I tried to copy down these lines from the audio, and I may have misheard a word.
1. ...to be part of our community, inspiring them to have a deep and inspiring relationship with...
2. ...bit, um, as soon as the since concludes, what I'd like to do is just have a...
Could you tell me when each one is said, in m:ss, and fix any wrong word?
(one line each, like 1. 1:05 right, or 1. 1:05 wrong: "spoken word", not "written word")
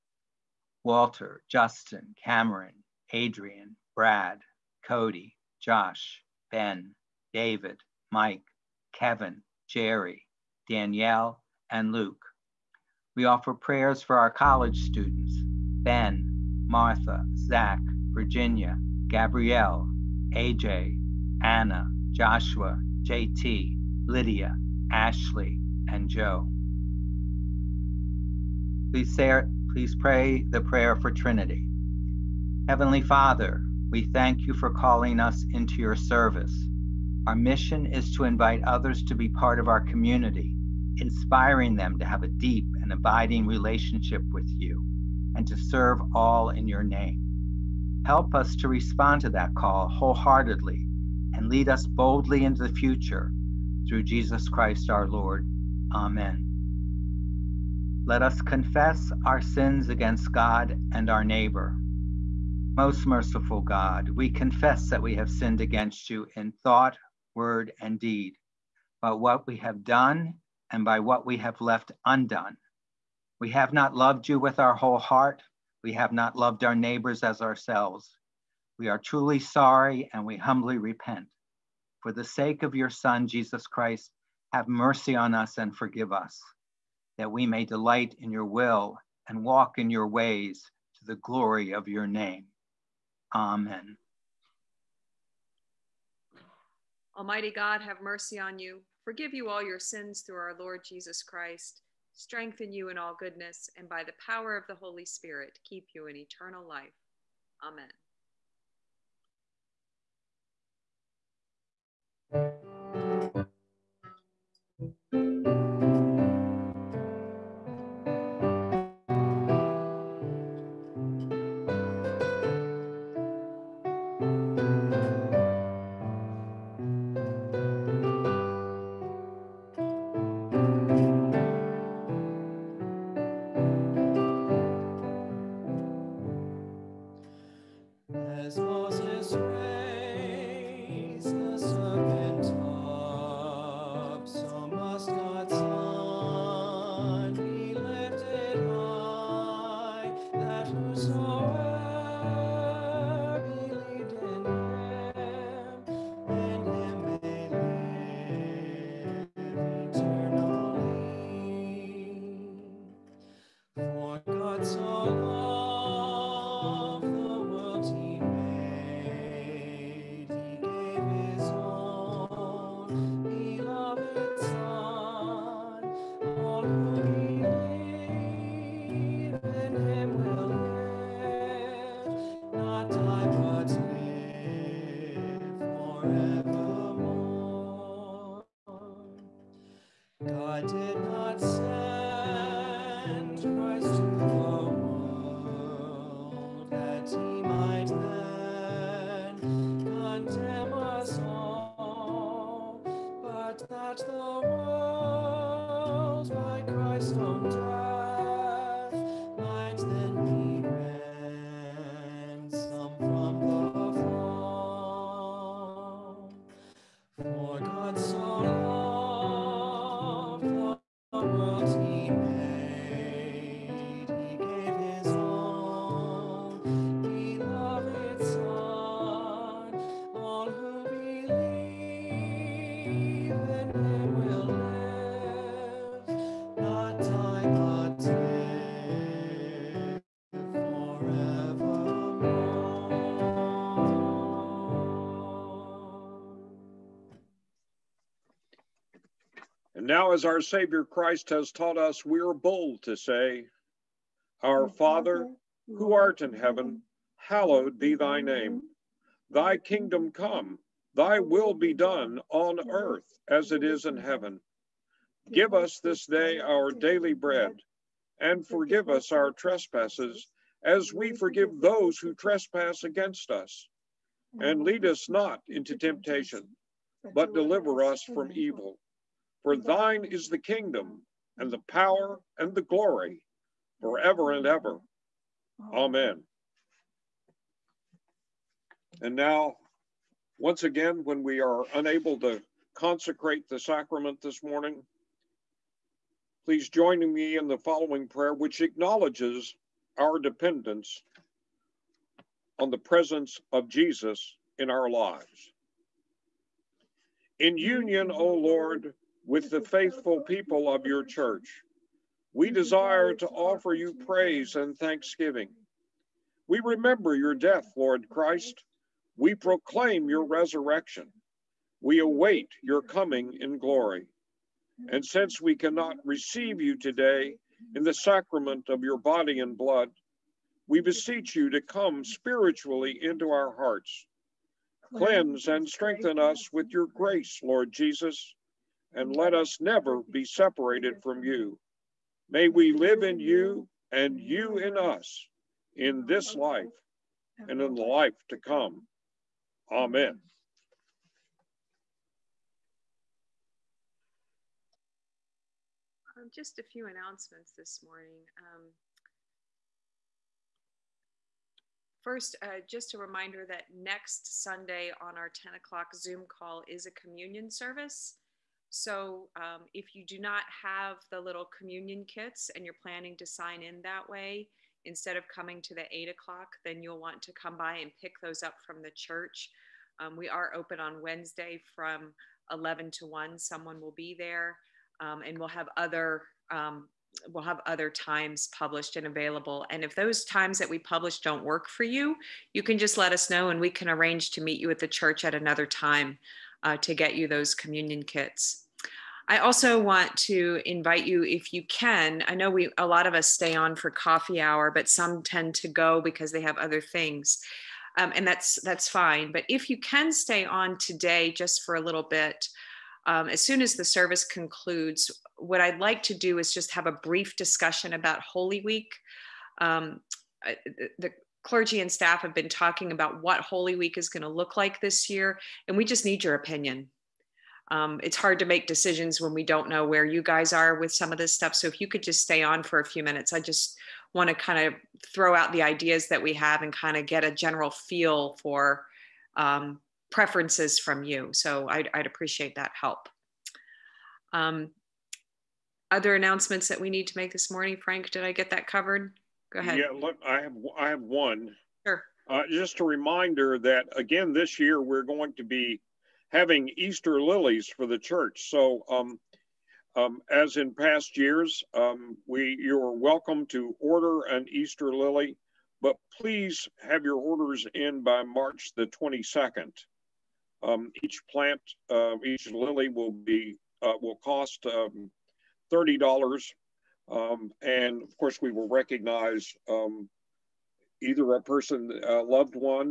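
1. 0:39 wrong: "abiding", not "inspiring"
2. 6:52 wrong: "service", not "since".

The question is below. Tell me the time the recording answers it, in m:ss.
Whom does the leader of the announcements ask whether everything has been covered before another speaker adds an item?
7:27.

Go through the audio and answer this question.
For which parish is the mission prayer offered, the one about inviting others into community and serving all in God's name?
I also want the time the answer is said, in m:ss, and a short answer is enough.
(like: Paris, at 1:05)
Trinity, at 0:31.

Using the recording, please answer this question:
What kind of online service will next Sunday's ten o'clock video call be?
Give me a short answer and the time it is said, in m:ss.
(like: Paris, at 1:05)
Communion service, at 6:06.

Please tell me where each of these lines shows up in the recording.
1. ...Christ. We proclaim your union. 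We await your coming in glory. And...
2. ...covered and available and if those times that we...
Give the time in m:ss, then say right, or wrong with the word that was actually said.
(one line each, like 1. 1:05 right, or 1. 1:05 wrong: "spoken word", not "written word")
1. 5:18 wrong: "resurrection", not "union"
2. 6:28 wrong: "published", not "covered".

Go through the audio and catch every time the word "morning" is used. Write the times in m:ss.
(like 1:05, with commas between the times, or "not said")
4:54, 5:57, 7:27.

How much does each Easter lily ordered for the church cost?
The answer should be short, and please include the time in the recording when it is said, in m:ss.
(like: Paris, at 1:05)
$30, at 7:55.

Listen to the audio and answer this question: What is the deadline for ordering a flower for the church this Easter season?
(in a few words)
March 22.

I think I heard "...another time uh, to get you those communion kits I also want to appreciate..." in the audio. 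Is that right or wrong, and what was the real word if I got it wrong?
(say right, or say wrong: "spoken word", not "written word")
wrong: "invite", not "appreciate".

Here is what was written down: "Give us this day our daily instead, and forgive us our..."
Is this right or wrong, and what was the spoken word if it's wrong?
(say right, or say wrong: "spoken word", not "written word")
wrong: "bread", not "instead".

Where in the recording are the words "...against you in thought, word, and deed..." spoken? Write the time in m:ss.
1:05.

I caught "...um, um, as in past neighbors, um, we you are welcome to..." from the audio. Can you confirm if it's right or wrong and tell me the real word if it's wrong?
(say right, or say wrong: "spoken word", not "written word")
wrong: "years", not "neighbors".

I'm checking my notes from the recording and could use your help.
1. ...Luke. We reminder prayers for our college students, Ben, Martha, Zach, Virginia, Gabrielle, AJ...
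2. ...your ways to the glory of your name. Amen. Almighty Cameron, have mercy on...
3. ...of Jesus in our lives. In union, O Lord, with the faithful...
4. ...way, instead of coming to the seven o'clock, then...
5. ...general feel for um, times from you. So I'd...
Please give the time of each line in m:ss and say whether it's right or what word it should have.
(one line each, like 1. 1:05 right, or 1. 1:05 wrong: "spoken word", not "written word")
1. 0:11 wrong: "offer", not "reminder"
2. 1:29 wrong: "God", not "Cameron"
3. 5:03 right
4. 6:14 wrong: "eight", not "seven"
5. 7:17 wrong: "preferences", not "times".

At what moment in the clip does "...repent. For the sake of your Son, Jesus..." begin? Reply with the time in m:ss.
1:20.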